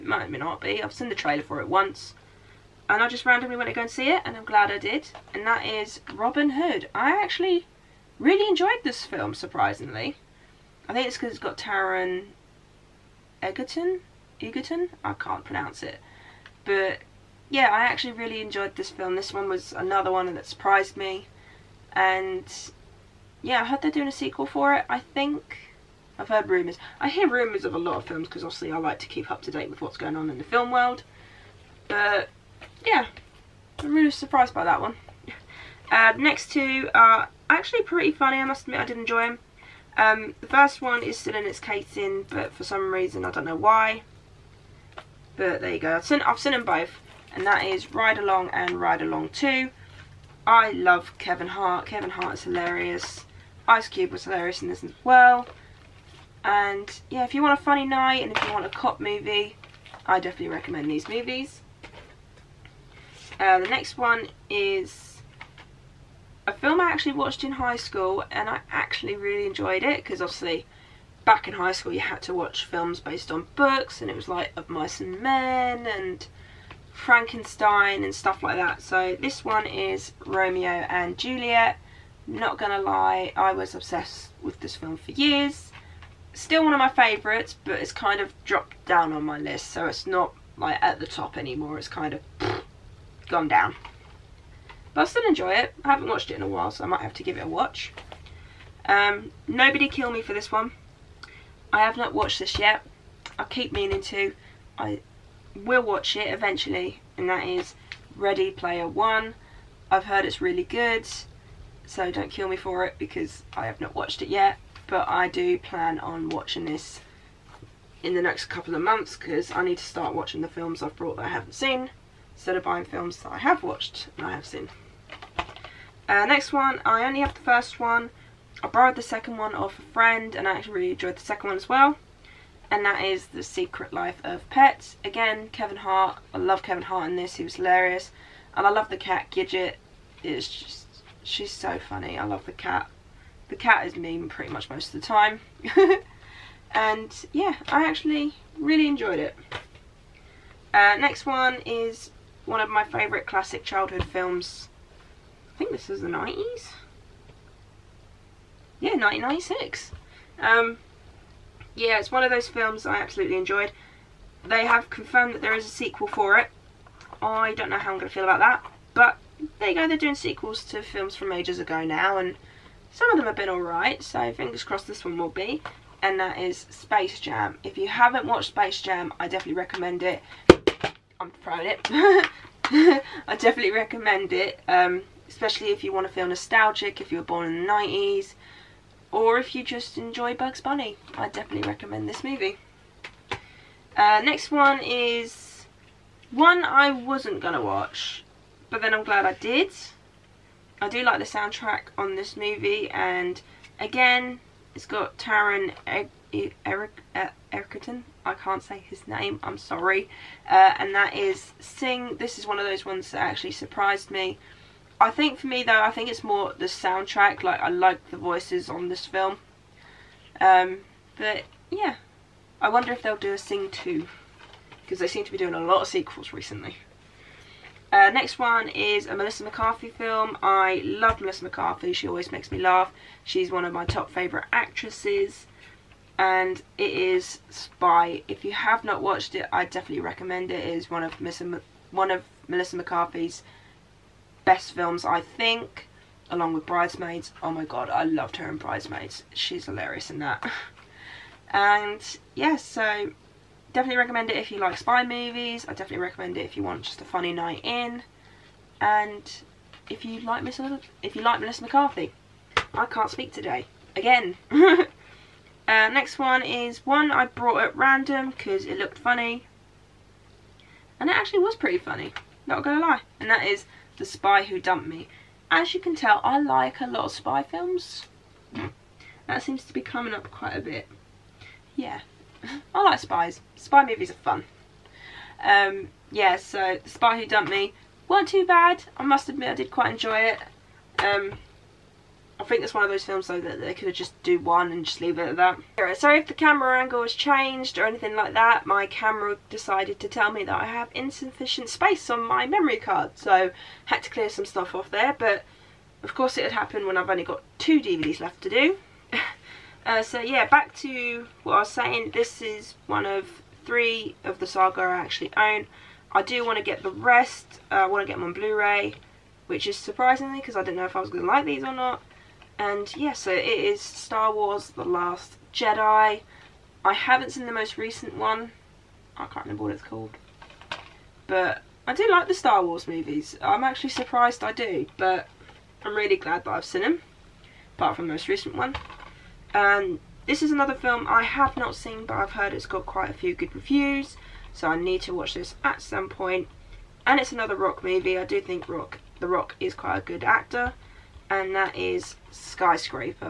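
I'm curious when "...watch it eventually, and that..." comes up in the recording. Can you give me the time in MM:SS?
01:45.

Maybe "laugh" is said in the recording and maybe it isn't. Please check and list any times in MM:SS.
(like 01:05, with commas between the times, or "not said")
03:52.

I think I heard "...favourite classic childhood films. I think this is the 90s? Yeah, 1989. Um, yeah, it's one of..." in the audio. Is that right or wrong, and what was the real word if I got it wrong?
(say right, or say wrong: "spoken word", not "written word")
wrong: "1996", not "1989".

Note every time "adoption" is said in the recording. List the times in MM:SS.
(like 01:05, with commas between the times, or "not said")
not said.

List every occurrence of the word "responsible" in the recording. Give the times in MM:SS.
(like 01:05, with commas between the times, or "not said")
not said.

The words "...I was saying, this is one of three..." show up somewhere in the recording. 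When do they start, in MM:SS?
05:11.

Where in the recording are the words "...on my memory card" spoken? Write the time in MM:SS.
05:02.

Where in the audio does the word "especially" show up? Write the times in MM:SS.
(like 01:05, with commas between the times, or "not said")
03:05.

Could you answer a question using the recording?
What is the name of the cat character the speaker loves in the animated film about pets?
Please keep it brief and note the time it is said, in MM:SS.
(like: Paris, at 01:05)
Gidget, at 02:19.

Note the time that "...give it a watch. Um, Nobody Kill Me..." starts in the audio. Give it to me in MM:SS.
01:37.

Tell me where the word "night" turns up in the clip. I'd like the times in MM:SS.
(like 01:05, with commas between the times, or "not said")
00:57, 04:17.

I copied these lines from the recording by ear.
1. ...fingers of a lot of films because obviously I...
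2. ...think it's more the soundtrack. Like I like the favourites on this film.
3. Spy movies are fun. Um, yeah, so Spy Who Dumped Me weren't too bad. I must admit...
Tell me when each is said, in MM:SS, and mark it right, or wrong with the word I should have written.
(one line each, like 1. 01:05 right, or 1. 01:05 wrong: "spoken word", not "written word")
1. 00:27 wrong: "rumours", not "fingers"
2. 03:35 wrong: "voices", not "favourites"
3. 04:43 right.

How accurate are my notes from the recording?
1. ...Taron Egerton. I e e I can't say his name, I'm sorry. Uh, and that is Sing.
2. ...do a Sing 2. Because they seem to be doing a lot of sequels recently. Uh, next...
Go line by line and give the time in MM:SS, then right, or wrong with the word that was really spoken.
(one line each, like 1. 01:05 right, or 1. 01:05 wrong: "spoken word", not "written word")
1. 03:25 right
2. 03:43 right.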